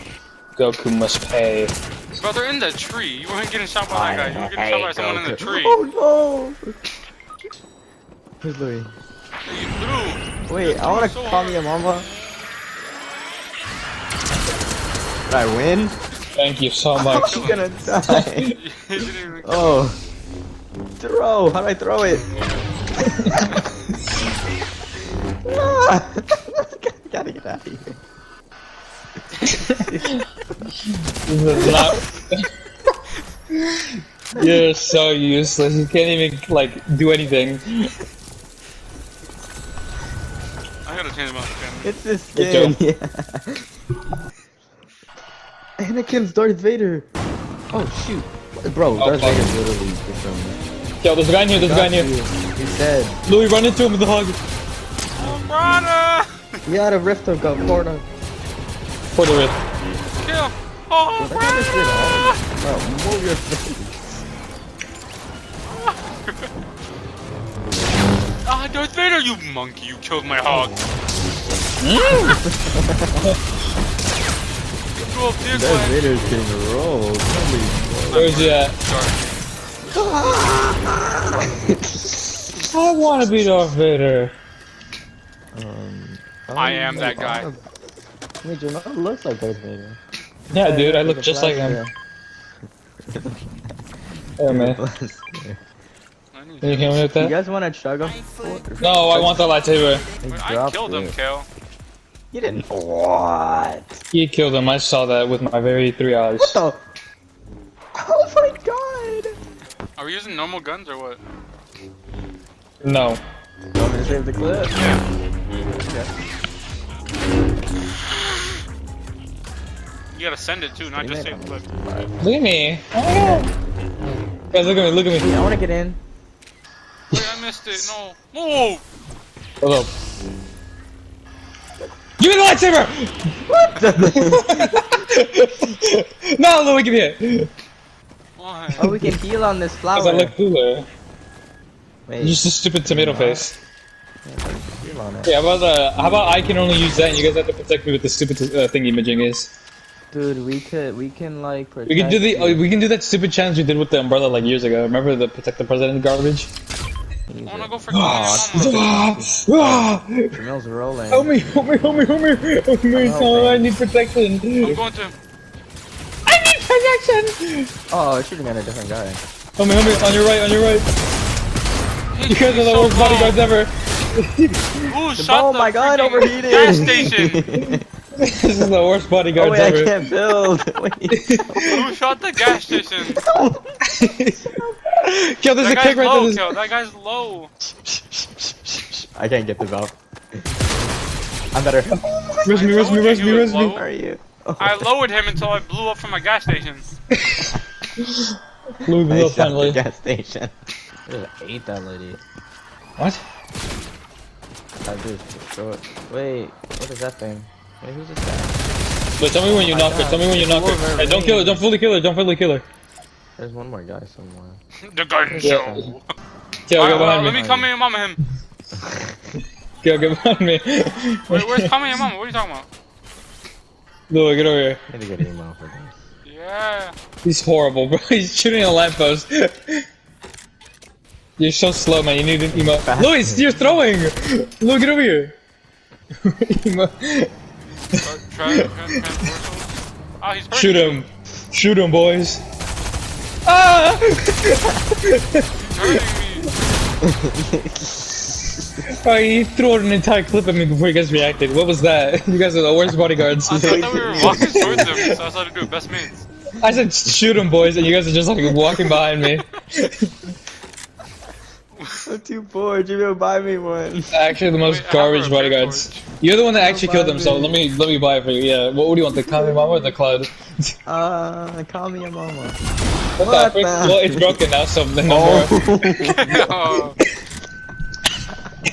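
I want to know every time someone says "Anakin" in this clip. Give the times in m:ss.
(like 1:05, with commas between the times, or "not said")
0:45.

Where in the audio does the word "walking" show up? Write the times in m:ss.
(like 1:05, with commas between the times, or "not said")
4:14, 4:18.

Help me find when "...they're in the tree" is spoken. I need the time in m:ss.
0:02.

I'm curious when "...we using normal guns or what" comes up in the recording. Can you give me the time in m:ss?
1:50.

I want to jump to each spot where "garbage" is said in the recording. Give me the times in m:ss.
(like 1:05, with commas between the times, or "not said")
2:36, 4:24.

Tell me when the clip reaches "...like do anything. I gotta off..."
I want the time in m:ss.
0:36.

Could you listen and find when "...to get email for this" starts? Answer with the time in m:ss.
3:45.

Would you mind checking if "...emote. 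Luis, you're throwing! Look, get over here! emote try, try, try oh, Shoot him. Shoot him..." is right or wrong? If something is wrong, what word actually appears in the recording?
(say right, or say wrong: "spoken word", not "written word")
right.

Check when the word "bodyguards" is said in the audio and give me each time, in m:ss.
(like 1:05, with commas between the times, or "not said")
2:52, 2:59, 4:12, 4:25.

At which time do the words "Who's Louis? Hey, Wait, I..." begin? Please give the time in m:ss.
0:08.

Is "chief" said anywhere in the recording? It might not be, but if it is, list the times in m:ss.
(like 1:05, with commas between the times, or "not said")
not said.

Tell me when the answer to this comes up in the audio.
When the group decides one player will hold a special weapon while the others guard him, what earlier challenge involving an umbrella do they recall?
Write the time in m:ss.
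2:35.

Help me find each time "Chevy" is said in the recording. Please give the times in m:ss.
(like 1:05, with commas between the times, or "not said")
not said.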